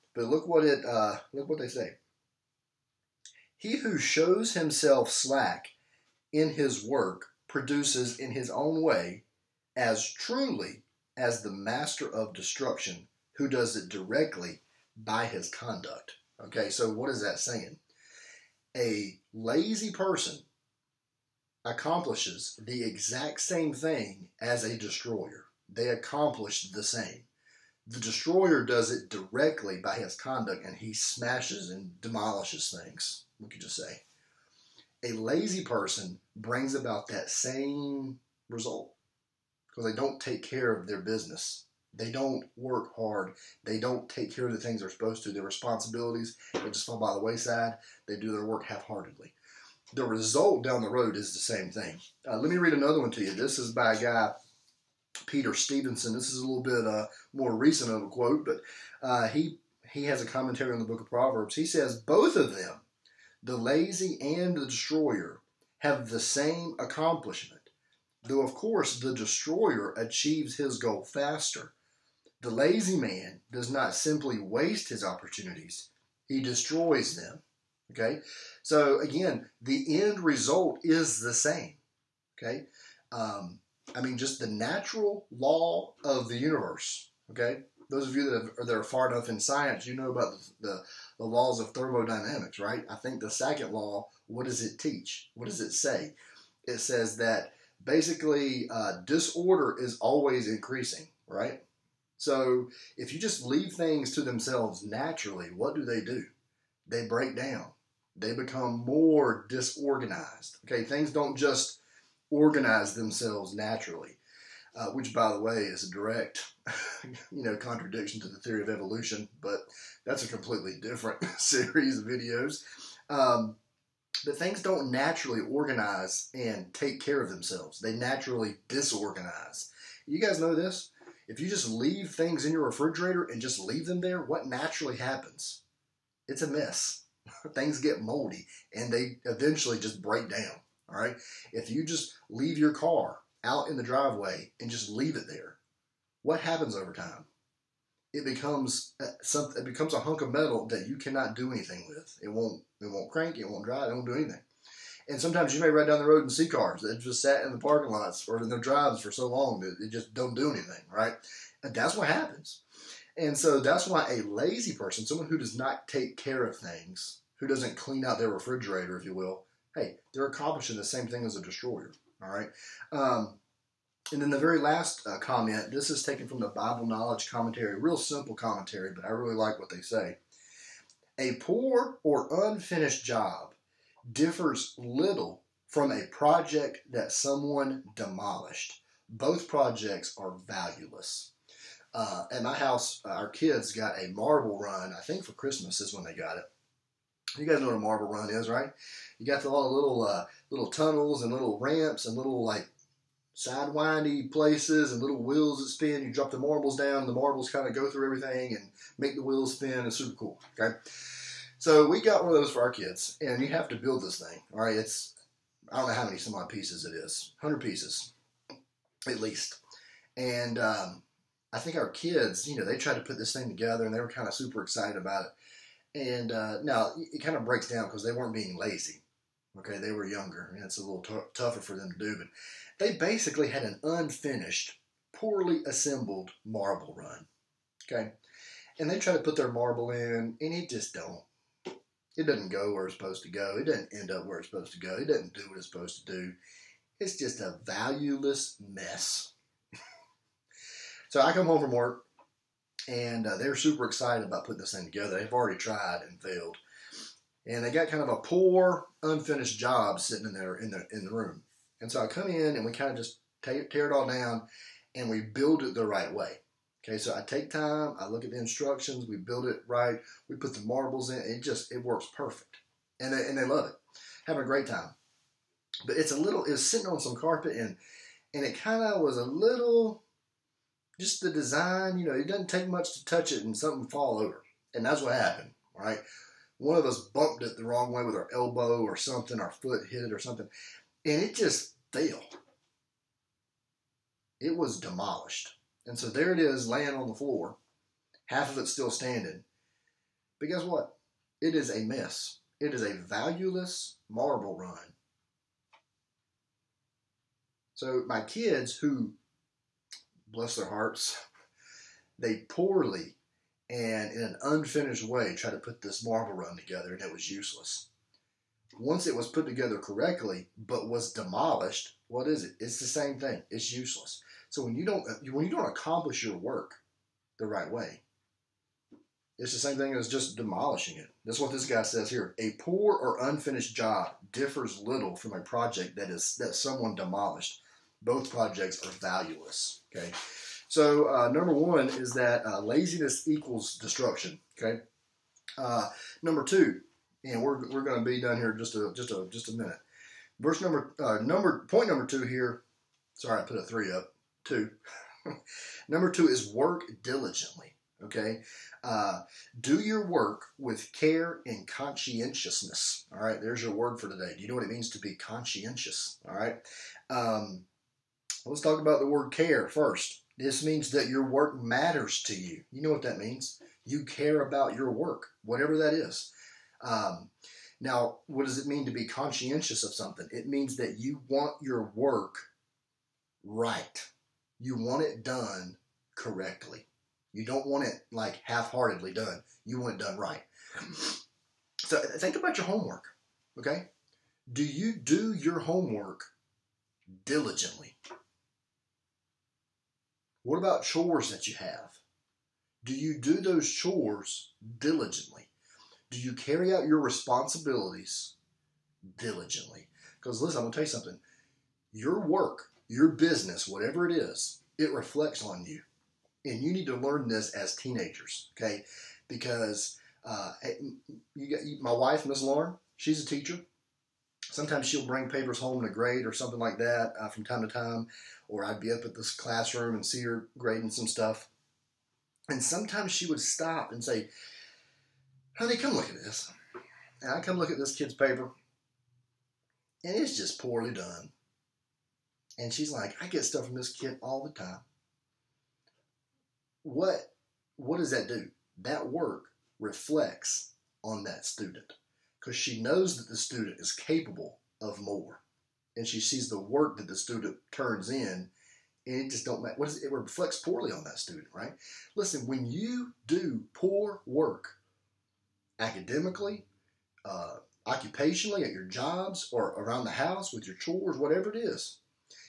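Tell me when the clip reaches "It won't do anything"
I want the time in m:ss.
2:33.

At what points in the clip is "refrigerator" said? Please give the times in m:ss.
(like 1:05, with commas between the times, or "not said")
2:12, 2:48.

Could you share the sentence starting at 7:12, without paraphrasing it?
And sometimes she would stop and say, Honey, come look at this.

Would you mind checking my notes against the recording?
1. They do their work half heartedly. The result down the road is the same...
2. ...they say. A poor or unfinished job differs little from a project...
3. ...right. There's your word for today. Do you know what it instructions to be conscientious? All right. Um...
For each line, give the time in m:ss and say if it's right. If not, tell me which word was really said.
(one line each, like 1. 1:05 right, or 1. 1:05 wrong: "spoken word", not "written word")
1. 0:48 right
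2. 2:59 right
3. 6:03 wrong: "means", not "instructions".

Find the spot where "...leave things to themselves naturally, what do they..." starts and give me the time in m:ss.
1:43.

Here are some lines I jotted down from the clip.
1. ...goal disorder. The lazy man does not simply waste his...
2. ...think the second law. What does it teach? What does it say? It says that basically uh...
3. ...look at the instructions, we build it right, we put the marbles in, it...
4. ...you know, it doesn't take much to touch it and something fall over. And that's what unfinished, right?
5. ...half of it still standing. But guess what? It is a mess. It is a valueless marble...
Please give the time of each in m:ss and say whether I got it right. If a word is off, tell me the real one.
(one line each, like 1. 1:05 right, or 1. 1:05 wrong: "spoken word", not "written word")
1. 1:10 wrong: "faster", not "disorder"
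2. 1:32 right
3. 4:28 right
4. 4:41 wrong: "happened", not "unfinished"
5. 4:58 right.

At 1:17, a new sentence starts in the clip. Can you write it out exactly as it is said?
Okay, so again, the end result is the same.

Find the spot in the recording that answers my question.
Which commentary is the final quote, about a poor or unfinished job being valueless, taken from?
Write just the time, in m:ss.
2:56.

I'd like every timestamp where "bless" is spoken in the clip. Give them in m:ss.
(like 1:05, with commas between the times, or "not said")
5:10.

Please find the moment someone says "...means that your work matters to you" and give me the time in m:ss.
6:10.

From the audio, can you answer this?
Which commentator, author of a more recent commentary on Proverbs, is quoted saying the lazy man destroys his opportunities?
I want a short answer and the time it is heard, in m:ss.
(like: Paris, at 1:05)
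Peter Steveson, at 0:55.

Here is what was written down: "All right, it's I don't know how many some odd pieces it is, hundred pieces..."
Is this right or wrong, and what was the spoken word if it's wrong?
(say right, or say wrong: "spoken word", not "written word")
right.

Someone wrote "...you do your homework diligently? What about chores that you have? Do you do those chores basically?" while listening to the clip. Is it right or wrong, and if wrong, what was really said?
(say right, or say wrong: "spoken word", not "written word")
wrong: "diligently", not "basically".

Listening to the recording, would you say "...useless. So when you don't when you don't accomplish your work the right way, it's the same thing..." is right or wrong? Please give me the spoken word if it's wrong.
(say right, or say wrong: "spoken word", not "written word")
right.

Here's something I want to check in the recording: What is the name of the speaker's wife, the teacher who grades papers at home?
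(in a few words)
Miss Lauren.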